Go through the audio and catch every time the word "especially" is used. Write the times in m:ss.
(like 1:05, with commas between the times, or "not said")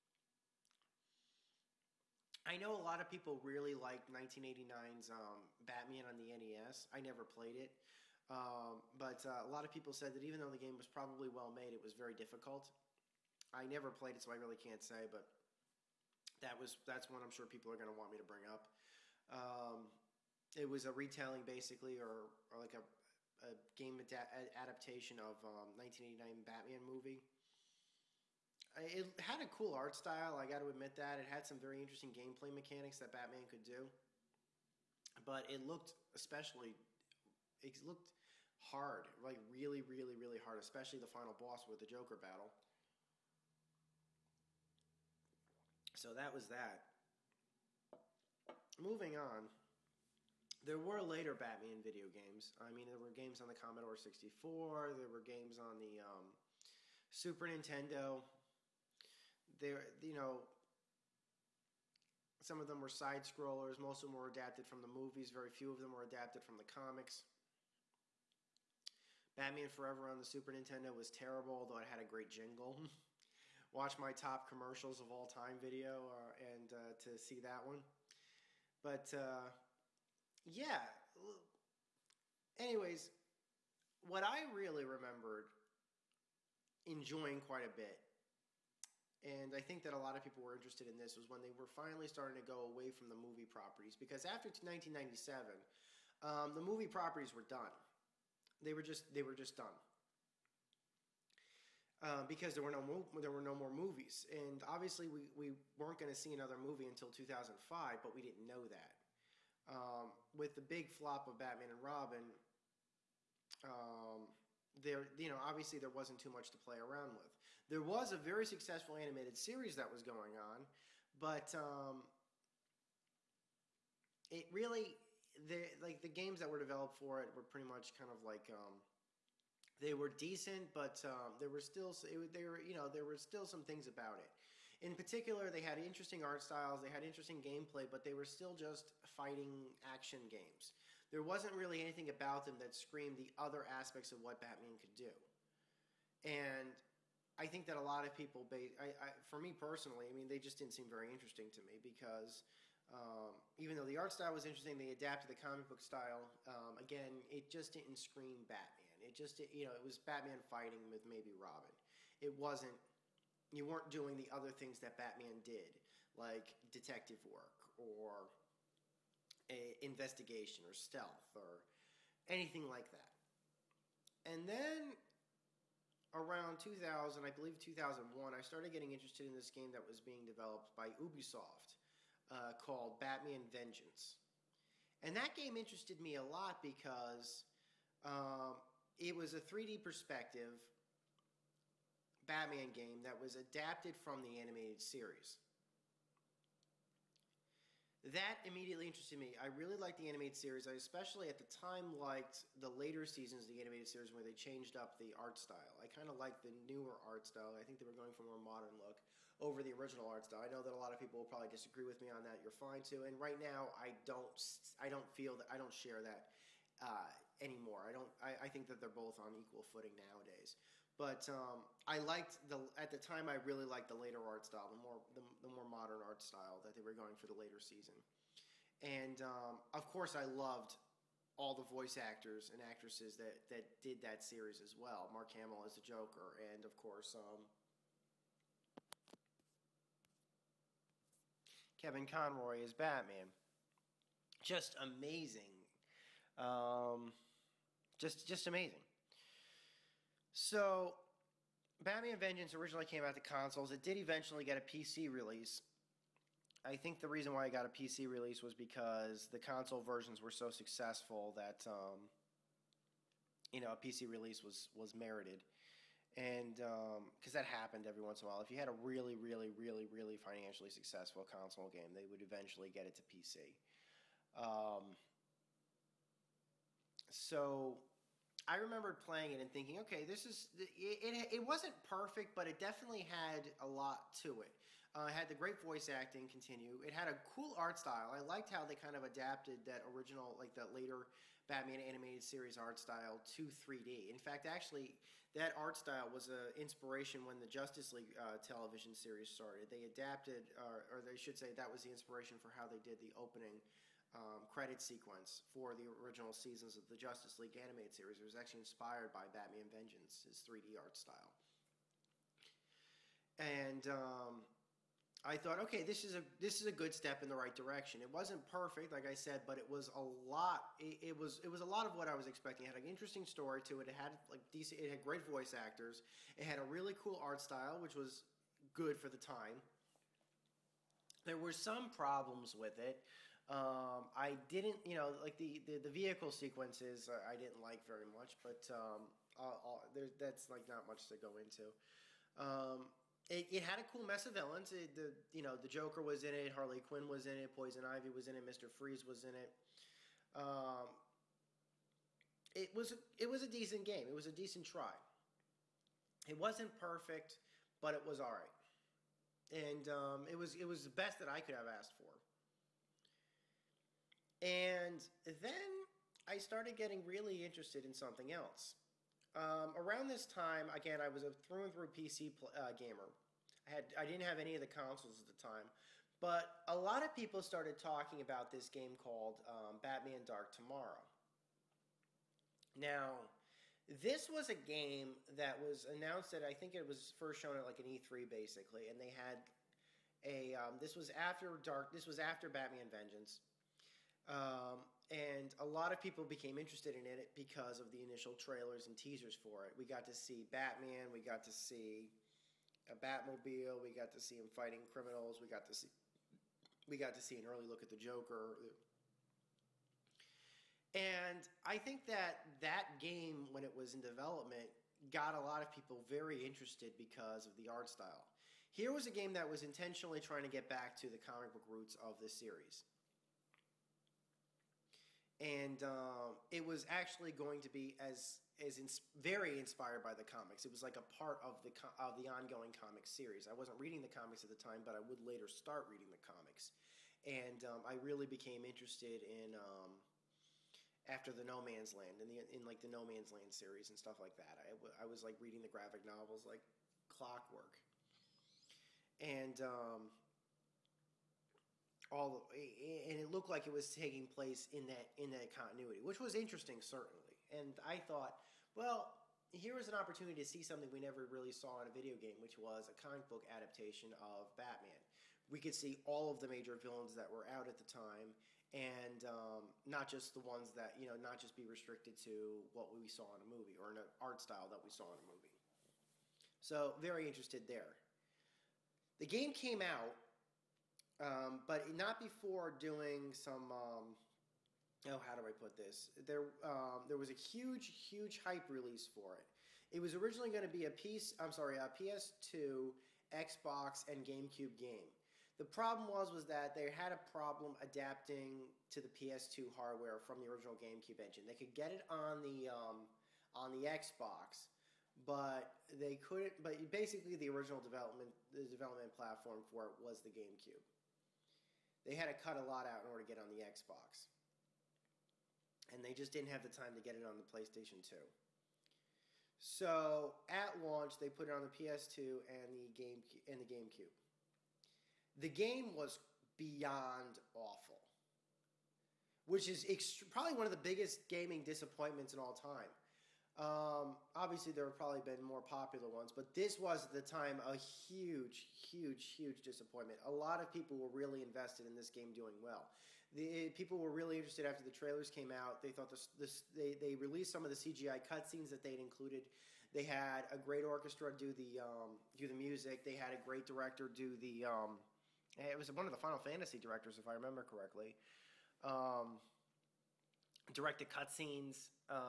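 0:36, 0:40, 3:20.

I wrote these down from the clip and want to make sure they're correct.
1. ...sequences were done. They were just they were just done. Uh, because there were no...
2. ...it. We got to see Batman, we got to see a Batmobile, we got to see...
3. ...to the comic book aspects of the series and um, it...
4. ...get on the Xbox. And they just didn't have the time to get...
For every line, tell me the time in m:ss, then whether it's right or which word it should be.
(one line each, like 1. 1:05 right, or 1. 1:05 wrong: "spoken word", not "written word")
1. 1:36 wrong: "properties", not "sequences"
2. 6:39 right
3. 7:00 wrong: "roots", not "aspects"
4. 8:33 right.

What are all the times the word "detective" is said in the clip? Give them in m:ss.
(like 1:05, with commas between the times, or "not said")
2:46.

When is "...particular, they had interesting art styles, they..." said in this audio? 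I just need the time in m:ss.
2:14.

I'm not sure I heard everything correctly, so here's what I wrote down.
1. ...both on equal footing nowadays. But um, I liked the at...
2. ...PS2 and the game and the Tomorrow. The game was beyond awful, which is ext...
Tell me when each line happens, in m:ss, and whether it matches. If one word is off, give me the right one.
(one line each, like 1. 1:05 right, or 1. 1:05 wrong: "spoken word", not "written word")
1. 3:38 right
2. 8:41 wrong: "GameCube", not "Tomorrow".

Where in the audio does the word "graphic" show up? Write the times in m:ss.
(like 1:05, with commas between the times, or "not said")
7:25.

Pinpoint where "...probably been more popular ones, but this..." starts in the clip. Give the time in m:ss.
8:54.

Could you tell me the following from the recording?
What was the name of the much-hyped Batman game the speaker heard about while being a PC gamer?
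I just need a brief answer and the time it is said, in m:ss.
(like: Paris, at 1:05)
Batman Dark Tomorrow, at 6:19.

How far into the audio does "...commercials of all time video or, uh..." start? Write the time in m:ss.
1:14.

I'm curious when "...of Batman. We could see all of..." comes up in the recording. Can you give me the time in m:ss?
7:44.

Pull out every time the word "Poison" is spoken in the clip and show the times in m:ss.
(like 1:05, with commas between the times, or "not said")
5:47.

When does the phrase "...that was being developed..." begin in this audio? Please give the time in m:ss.
2:59.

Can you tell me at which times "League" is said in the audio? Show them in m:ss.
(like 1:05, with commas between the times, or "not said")
4:57, 5:07.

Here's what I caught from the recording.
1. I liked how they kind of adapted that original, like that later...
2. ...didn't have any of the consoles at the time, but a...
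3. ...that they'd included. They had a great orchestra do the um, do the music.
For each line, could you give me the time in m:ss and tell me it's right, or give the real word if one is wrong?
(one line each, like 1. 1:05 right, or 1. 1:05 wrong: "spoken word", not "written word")
1. 4:48 right
2. 6:14 right
3. 9:08 right.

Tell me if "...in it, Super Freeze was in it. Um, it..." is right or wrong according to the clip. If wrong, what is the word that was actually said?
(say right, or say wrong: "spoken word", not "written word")
wrong: "Mister", not "Super".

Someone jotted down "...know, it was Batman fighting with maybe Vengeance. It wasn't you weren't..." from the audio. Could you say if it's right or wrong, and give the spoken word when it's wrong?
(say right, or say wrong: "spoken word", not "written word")
wrong: "Robin", not "Vengeance".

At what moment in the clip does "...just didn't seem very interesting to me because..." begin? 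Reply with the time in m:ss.
2:30.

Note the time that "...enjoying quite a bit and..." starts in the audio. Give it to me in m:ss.
1:26.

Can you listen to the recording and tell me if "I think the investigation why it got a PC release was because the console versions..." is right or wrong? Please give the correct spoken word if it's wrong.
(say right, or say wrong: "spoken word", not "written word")
wrong: "reason", not "investigation".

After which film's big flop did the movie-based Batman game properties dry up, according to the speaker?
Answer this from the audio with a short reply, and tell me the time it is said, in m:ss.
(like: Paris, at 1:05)
Batman and Robin, at 1:51.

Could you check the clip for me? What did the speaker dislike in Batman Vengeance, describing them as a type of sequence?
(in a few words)
vehicle sequences.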